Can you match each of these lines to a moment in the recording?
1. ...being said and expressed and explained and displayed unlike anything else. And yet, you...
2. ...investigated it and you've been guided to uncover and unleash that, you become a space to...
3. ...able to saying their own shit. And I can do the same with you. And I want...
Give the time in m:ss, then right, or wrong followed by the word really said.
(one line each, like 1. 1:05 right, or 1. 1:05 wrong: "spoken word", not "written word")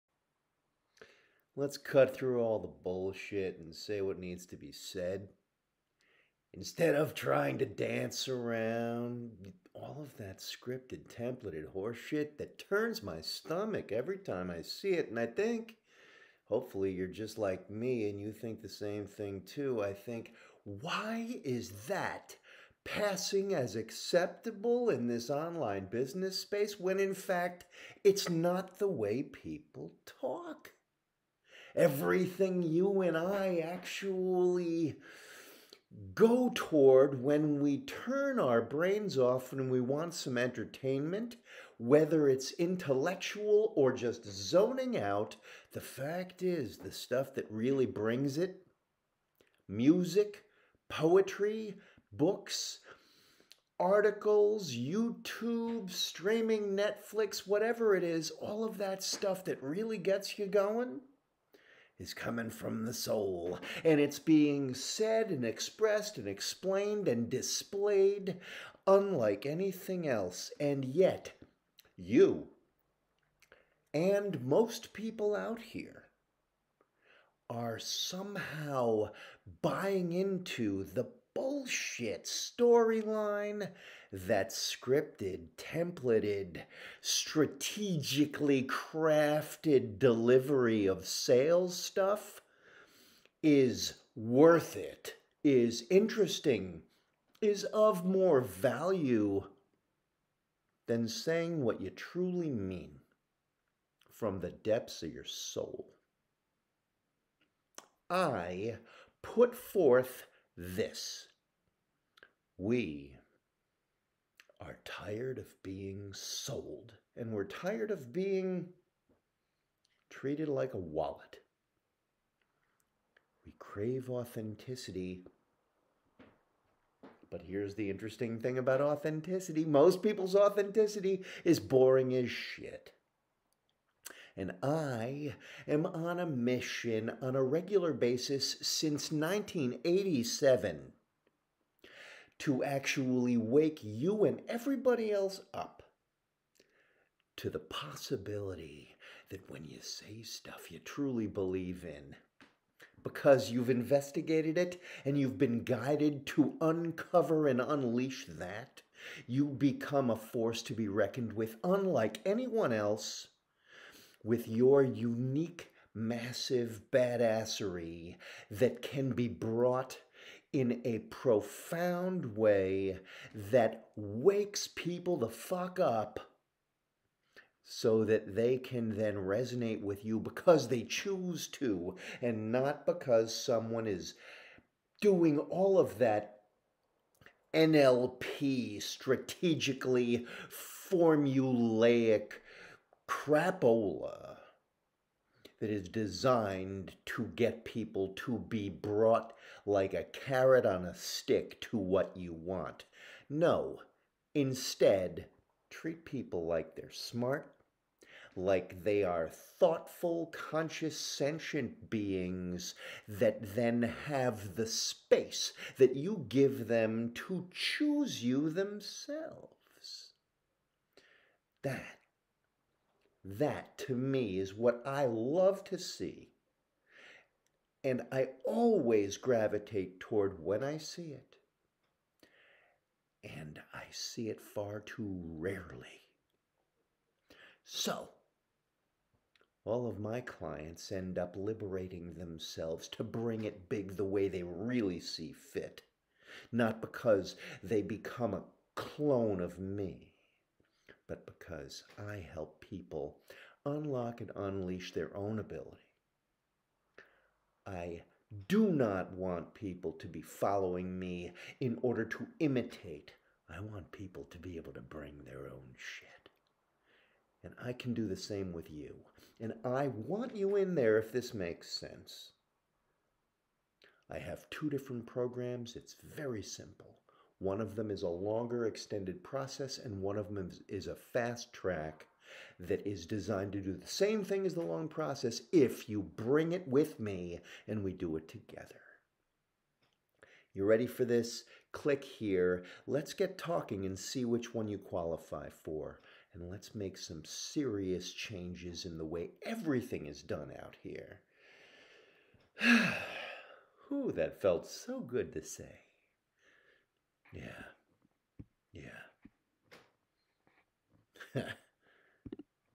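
1. 1:04 right
2. 2:33 wrong: "force", not "space"
3. 4:24 wrong: "bring", not "saying".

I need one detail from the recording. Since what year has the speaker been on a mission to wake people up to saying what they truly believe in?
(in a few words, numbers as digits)
1987.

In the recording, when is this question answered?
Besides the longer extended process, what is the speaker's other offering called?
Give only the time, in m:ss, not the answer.
4:40.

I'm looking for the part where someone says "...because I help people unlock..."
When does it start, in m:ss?
4:11.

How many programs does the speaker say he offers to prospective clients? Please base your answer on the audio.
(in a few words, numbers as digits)
2.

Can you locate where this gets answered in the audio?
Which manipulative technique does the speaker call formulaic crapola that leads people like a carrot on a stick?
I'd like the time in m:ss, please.
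3:07.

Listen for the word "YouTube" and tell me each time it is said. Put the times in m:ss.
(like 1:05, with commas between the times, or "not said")
0:54.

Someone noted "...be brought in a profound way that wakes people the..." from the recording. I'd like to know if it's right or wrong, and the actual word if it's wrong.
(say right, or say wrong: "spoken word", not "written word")
right.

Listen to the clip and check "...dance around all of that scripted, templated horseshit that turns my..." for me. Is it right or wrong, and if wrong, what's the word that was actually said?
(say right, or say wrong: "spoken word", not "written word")
right.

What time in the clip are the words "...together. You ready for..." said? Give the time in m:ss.
4:48.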